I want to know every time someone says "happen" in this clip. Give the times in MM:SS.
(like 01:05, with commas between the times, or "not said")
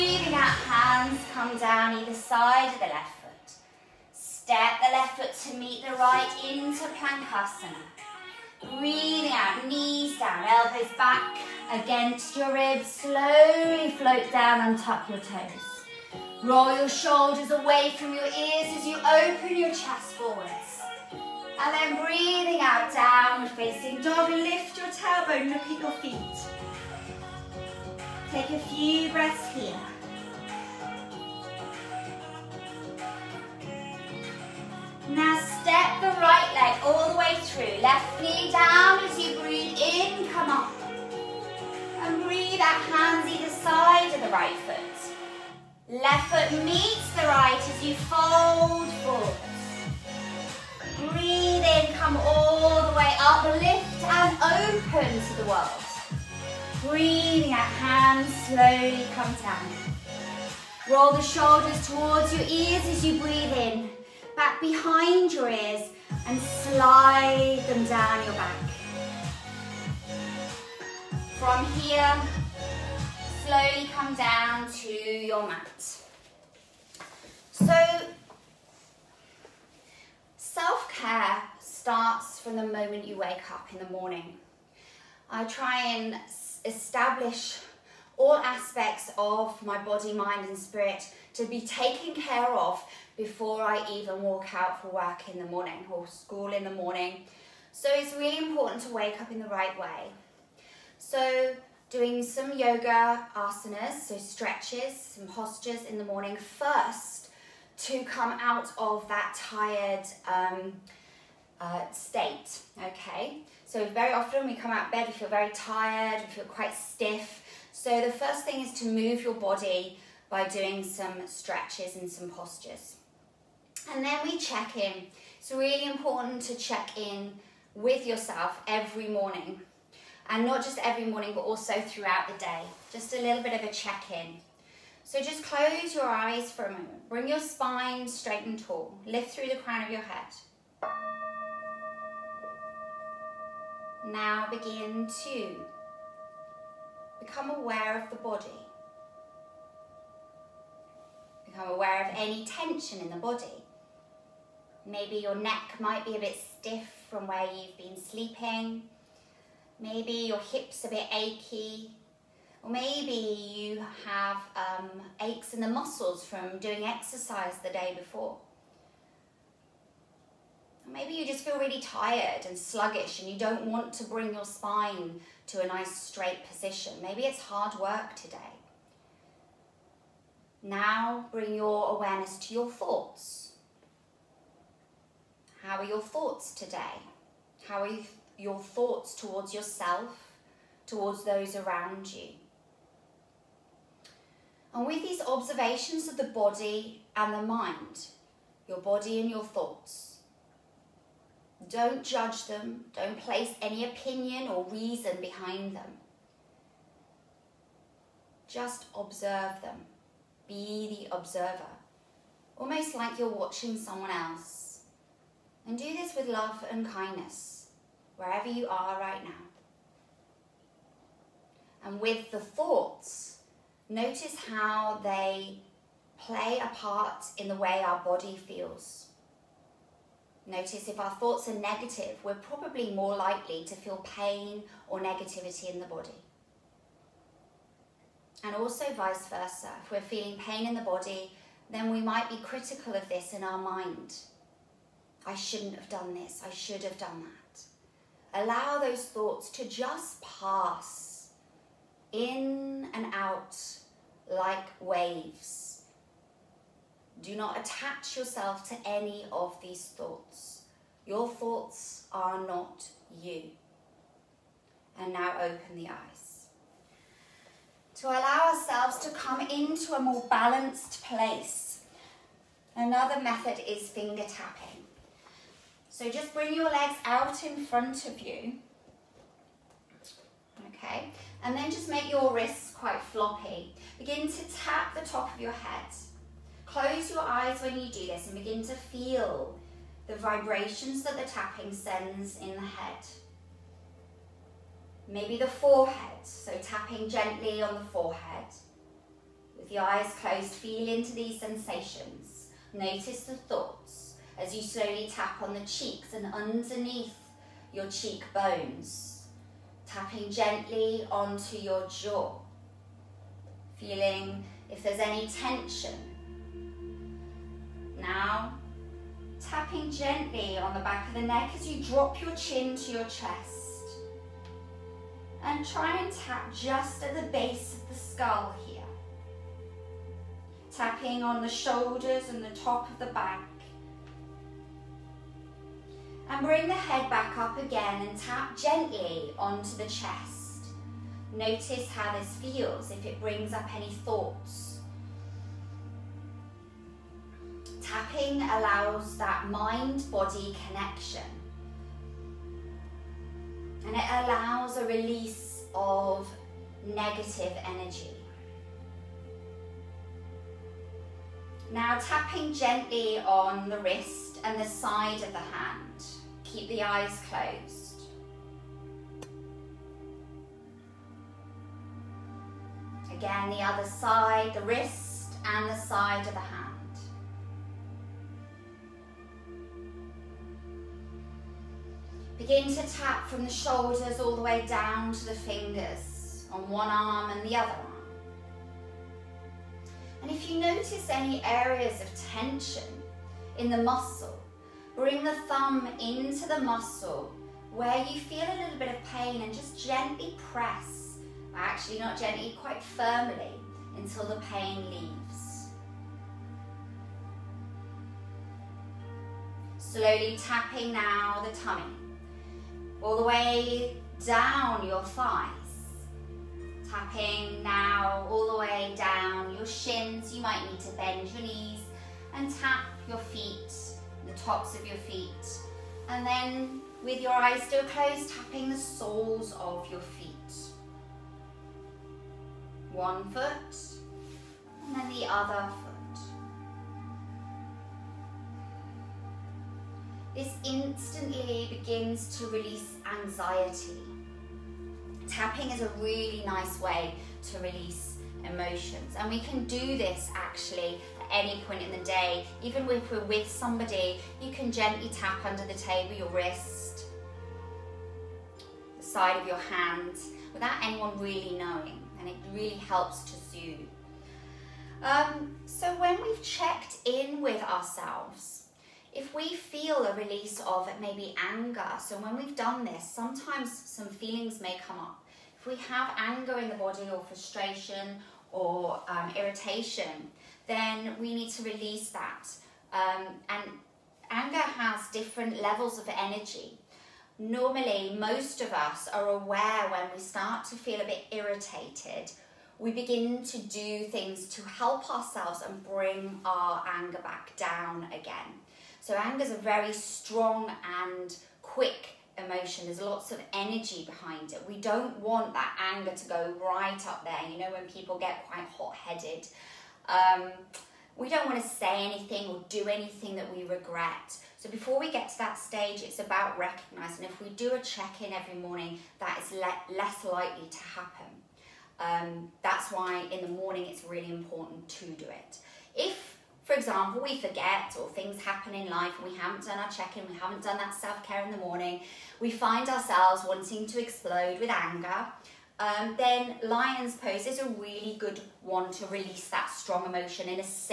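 08:40, 08:48.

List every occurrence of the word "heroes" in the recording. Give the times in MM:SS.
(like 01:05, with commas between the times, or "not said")
not said.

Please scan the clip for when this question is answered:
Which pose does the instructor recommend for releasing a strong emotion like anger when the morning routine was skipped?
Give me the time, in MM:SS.
08:56.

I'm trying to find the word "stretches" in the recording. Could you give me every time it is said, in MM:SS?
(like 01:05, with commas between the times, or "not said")
01:44, 02:01.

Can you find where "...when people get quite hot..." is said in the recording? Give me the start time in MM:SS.
08:27.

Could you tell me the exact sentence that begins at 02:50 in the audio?
Maybe you just feel really tired and sluggish and you don't want to bring your spine to a nice straight position.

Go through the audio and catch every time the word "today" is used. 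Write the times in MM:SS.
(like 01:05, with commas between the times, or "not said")
02:58, 03:06.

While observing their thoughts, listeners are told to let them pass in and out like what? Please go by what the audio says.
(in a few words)
Waves.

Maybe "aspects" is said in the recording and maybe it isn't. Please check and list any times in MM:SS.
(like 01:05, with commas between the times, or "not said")
01:28.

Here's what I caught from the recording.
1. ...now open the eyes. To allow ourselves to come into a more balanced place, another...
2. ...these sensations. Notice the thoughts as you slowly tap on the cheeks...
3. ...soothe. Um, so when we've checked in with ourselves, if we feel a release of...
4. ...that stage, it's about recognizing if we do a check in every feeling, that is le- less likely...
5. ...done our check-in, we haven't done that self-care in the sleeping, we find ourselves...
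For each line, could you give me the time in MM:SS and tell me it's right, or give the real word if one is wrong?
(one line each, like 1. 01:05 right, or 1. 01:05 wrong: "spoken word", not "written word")
1. 04:25 right
2. 05:01 right
3. 07:43 right
4. 08:35 wrong: "morning", not "feeling"
5. 08:49 wrong: "morning", not "sleeping".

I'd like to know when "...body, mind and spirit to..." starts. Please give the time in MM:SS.
01:29.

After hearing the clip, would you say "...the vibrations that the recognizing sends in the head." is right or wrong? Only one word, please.
wrong.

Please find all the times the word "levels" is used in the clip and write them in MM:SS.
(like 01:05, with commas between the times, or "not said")
08:05.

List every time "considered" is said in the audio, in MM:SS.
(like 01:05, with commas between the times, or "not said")
not said.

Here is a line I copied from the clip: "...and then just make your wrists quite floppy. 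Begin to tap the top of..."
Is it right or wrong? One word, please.
right.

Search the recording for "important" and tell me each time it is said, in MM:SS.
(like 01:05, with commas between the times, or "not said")
01:38, 02:05, 08:44.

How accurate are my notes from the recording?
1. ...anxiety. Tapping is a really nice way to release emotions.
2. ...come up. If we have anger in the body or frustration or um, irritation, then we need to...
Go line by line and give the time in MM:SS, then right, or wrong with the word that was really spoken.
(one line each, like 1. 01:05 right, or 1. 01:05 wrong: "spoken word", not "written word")
1. 07:23 right
2. 07:54 right.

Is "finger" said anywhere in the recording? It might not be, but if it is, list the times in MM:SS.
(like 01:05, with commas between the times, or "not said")
04:33, 06:25.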